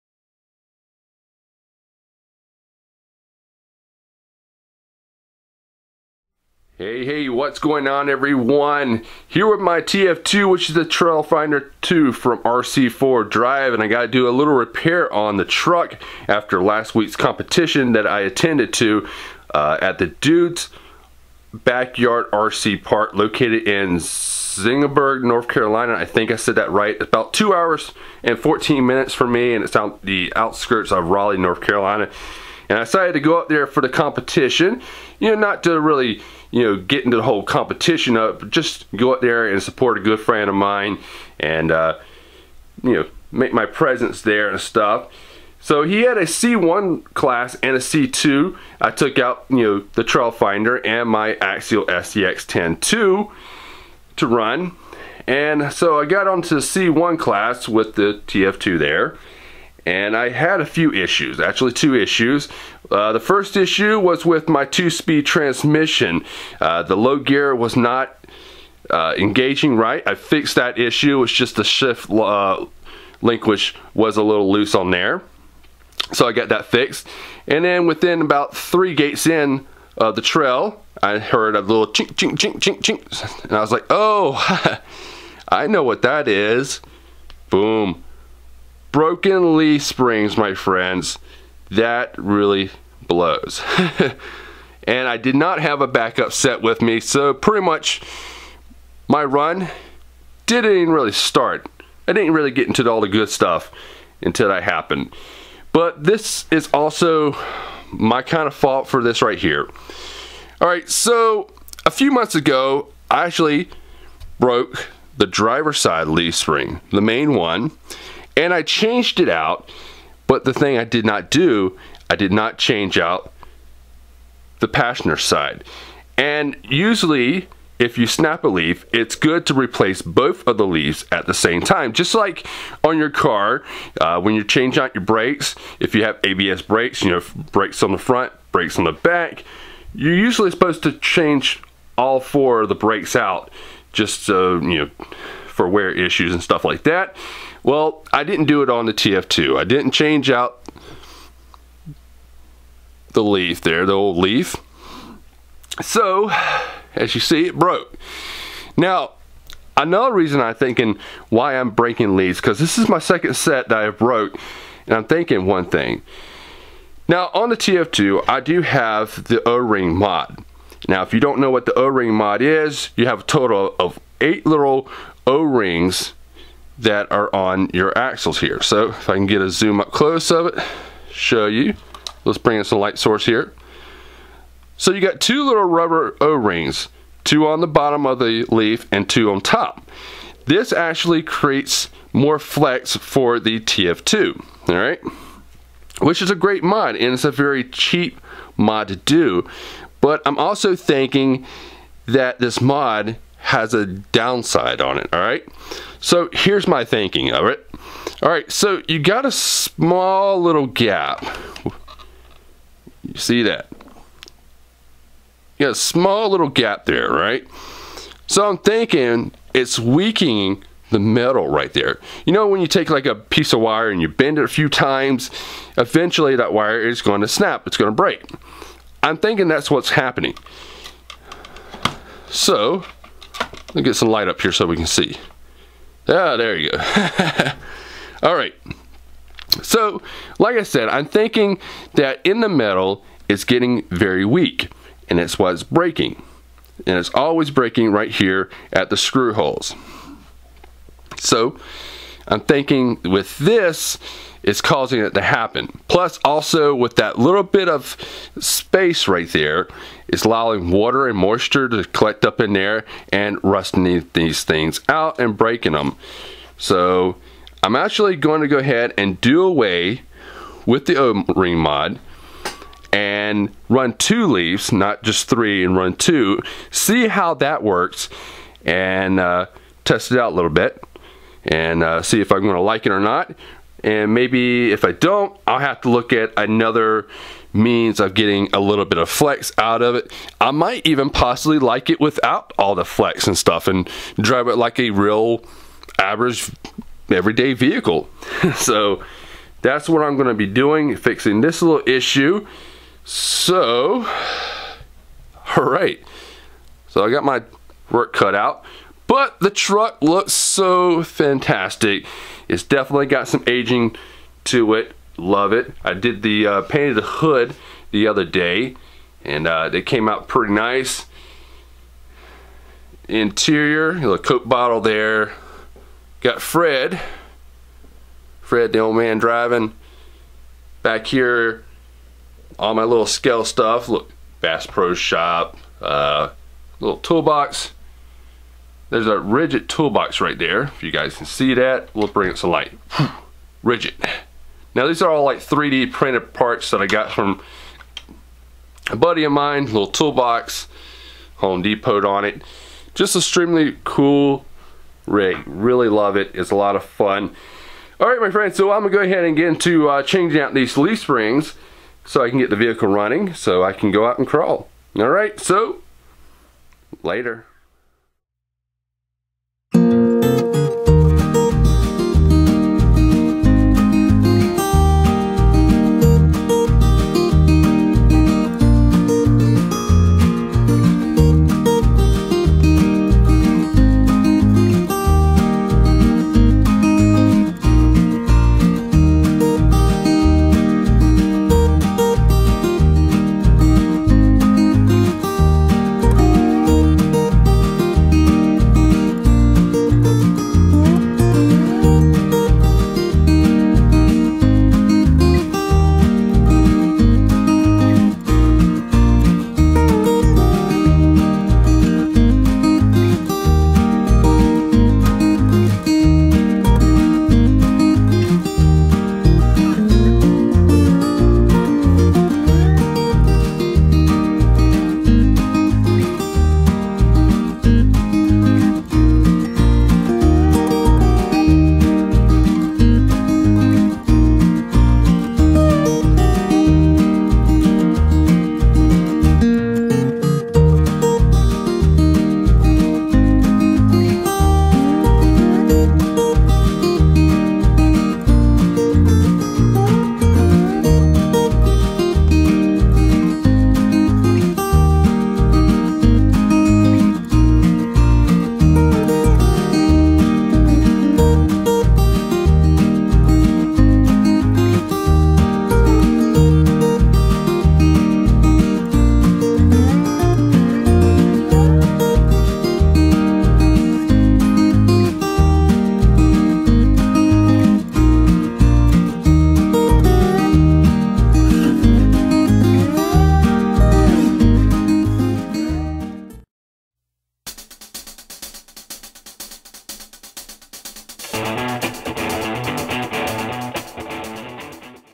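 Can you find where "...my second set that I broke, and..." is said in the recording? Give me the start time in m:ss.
2:42.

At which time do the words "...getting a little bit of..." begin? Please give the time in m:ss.
4:48.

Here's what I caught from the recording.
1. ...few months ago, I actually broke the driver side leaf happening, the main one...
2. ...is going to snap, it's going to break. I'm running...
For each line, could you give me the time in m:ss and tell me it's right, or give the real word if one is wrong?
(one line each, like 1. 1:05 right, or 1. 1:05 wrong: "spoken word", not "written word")
1. 1:51 wrong: "spring", not "happening"
2. 3:46 wrong: "thinking", not "running".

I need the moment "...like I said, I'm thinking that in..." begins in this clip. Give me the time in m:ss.
4:00.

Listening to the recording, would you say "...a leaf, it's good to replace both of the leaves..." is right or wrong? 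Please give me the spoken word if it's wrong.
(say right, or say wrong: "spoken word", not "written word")
right.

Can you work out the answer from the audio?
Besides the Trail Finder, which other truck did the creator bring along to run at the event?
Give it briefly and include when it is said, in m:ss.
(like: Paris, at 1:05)
Axial SCX 10-2, at 0:51.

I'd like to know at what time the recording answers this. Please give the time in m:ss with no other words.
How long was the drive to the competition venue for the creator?
0:27.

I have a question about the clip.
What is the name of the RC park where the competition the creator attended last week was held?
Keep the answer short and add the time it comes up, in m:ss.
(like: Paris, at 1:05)
Dude's Backyard RC Park, at 0:20.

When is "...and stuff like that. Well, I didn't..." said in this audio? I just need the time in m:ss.
2:26.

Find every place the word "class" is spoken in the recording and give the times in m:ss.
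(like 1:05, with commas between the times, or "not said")
0:47, 0:57.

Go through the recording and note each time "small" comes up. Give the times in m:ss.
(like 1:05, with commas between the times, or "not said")
3:29, 3:35.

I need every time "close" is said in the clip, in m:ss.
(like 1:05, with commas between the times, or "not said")
2:59.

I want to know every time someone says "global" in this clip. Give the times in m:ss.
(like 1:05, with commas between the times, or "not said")
not said.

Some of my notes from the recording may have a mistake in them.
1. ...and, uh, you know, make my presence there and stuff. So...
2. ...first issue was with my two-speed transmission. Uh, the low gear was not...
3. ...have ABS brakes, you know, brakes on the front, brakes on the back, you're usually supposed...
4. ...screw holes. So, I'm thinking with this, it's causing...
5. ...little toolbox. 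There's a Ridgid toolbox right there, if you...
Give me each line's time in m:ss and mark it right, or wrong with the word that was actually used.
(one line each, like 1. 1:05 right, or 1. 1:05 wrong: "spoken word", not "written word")
1. 0:41 right
2. 1:03 right
3. 2:16 right
4. 4:08 right
5. 5:36 right.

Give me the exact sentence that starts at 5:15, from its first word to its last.
I did the uh, painted the hood the other day and uh, they came out pretty nice.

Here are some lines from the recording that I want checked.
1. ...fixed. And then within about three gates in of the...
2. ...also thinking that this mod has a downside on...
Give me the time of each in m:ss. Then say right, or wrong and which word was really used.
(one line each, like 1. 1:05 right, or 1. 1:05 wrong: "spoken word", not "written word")
1. 1:16 right
2. 3:20 right.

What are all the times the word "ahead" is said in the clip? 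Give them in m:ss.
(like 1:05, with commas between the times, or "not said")
4:28, 5:59.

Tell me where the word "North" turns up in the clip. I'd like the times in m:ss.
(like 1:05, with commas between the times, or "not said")
0:25, 0:31.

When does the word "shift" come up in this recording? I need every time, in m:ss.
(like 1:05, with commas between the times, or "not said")
1:11.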